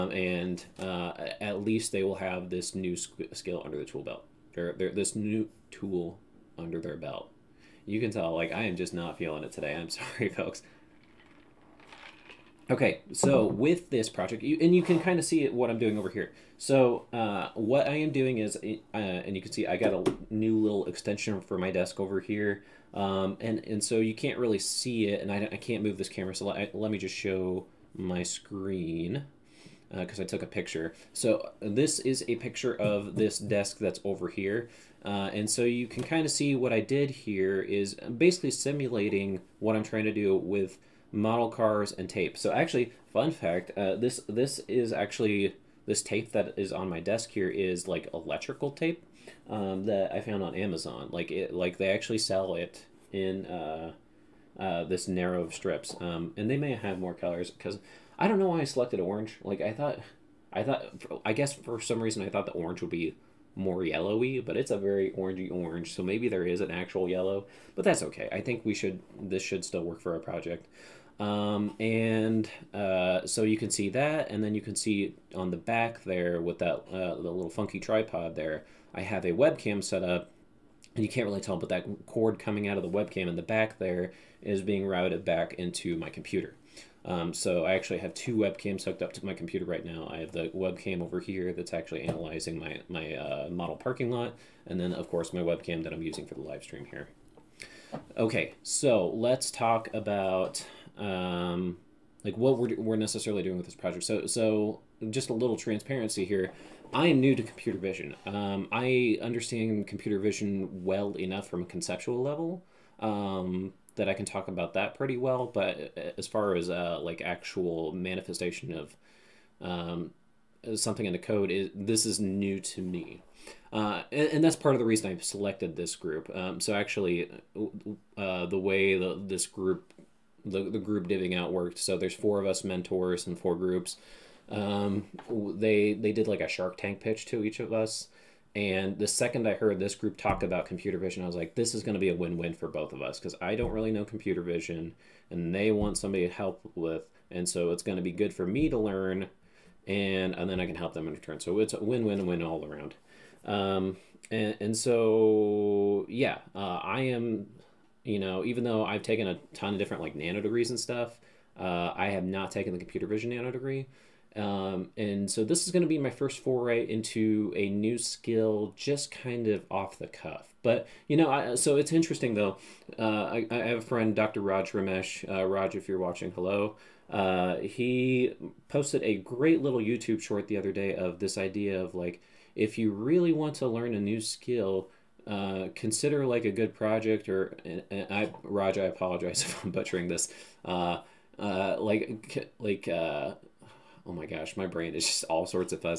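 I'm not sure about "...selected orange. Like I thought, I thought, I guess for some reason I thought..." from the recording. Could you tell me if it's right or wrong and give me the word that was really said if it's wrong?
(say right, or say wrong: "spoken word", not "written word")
right.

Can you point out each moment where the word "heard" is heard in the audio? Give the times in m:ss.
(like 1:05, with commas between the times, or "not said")
2:19.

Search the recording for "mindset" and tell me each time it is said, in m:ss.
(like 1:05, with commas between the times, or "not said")
not said.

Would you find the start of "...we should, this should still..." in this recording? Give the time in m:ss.
1:08.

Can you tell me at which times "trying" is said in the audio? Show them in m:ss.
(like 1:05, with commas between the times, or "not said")
0:39.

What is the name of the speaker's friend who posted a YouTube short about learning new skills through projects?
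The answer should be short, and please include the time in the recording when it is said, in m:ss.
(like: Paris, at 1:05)
Dr. Raj Ramesh, at 2:54.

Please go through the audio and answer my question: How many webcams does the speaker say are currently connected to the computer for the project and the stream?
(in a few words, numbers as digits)
2.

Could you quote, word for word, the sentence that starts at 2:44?
Um, and so this is going to be my first foray into a new skill, just kind of off the cuff.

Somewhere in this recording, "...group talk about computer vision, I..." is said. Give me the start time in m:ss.
2:19.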